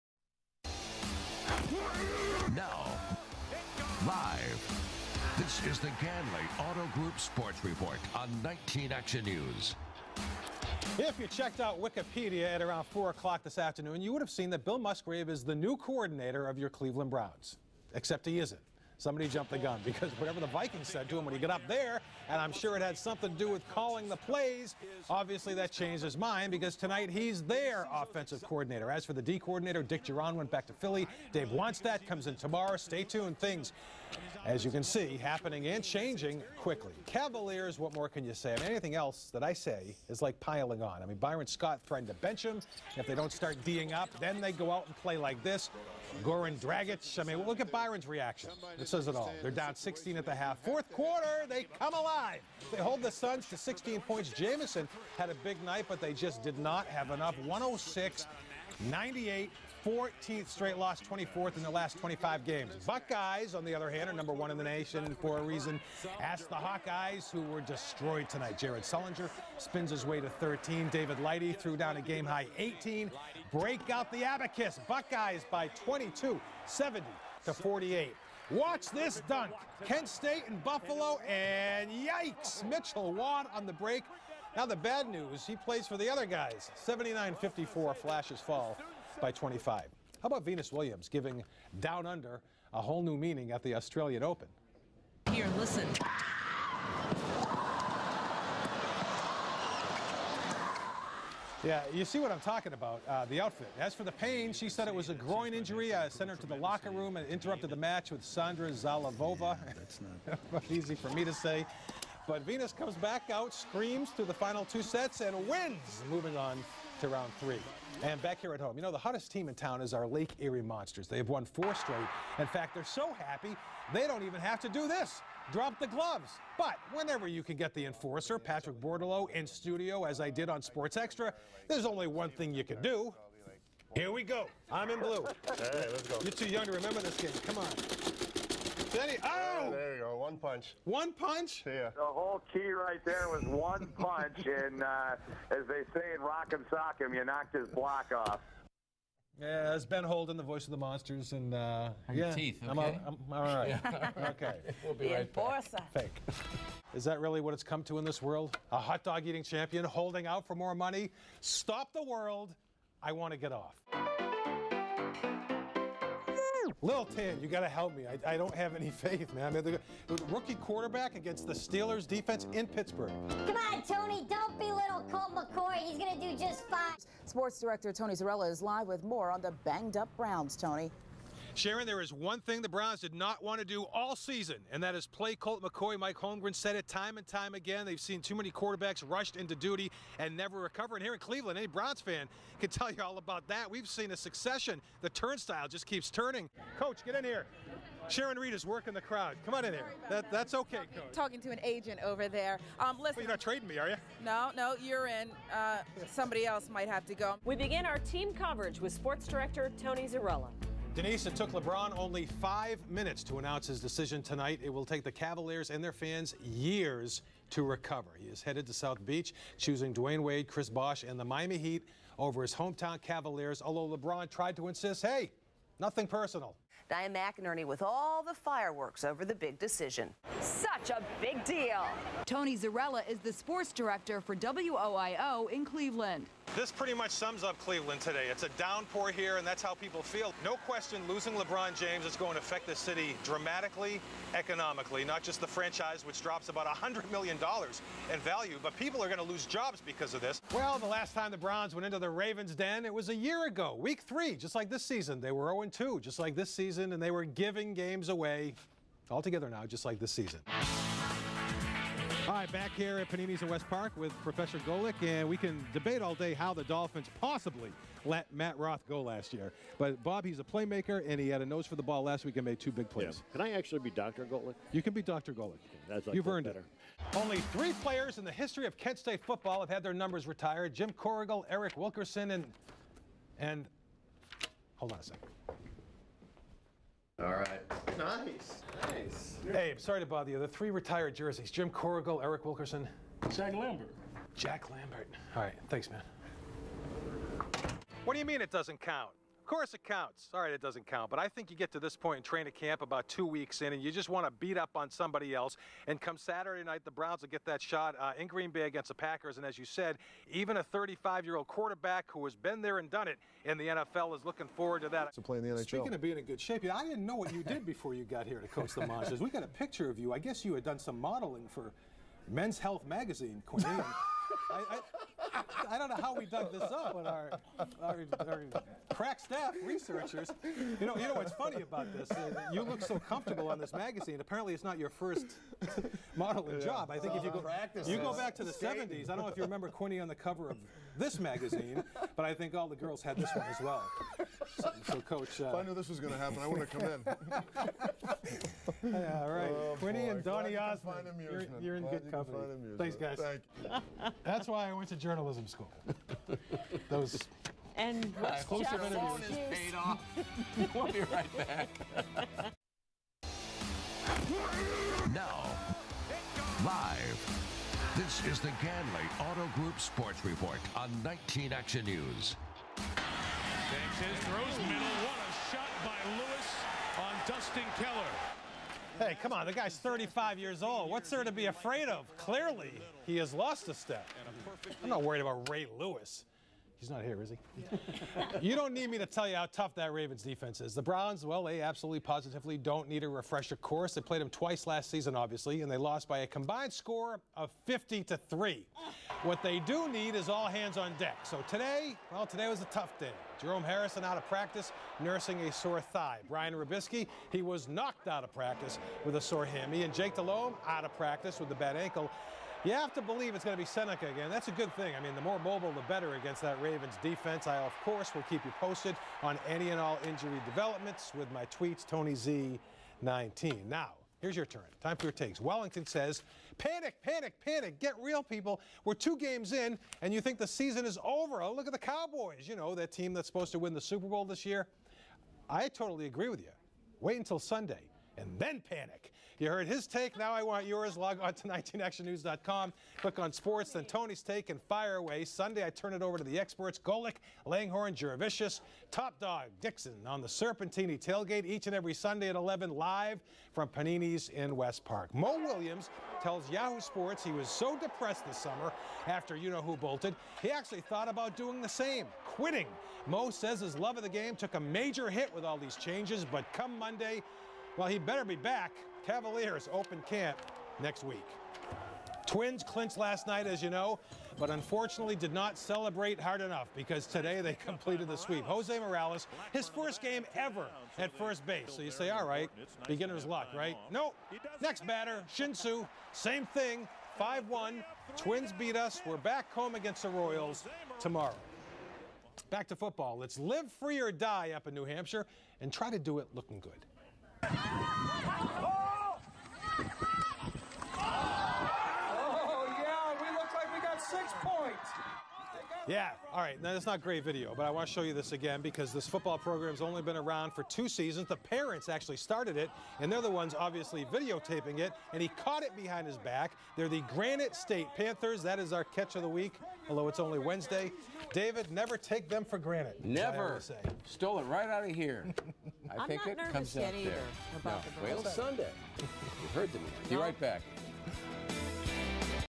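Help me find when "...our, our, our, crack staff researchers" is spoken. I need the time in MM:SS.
05:27.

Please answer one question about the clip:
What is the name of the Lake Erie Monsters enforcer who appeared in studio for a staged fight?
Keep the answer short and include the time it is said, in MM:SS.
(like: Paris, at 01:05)
Patrick Bordeleau, at 02:08.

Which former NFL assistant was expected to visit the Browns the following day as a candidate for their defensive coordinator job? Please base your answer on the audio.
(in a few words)
Dave Wannstedt.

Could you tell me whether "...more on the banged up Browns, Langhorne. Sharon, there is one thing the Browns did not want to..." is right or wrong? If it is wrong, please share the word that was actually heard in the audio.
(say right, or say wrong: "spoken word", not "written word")
wrong: "Tony", not "Langhorne".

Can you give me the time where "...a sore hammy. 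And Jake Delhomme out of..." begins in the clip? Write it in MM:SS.
06:49.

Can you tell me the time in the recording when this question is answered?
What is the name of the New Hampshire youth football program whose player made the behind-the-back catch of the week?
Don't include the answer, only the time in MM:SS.
08:37.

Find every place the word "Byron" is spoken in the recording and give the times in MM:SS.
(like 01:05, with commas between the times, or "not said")
00:41, 00:47.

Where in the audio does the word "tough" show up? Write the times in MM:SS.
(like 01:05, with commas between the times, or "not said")
06:29, 06:42.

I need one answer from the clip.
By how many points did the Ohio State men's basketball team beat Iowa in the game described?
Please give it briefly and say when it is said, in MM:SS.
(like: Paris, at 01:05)
22, at 01:14.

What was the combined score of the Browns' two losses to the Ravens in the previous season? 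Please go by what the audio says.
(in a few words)
50 to 3.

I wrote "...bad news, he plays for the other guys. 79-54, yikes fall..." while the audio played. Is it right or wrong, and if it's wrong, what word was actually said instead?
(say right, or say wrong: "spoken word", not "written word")
wrong: "flashes", not "yikes".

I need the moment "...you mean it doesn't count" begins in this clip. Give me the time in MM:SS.
04:58.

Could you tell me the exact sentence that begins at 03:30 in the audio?
Denise, it took LeBron only five minutes to announce his decision tonight.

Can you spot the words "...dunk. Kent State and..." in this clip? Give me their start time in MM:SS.
01:19.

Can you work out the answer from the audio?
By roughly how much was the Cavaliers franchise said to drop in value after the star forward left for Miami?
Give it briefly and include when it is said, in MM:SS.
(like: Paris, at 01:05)
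$100 million, at 04:06.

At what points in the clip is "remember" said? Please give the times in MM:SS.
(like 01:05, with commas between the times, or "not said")
02:16, 05:39.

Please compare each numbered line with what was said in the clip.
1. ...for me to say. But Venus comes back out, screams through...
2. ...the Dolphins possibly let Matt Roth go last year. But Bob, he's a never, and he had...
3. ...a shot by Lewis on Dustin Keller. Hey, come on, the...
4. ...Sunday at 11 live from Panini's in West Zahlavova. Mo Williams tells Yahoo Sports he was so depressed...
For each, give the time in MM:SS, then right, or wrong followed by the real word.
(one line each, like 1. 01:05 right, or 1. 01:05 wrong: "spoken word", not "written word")
1. 01:50 right
2. 04:26 wrong: "playmaker", not "never"
3. 06:15 right
4. 07:31 wrong: "Park", not "Zahlavova".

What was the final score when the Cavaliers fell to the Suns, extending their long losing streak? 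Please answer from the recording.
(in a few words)
106-98.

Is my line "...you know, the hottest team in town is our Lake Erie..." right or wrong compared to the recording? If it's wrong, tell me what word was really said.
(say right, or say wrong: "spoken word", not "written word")
right.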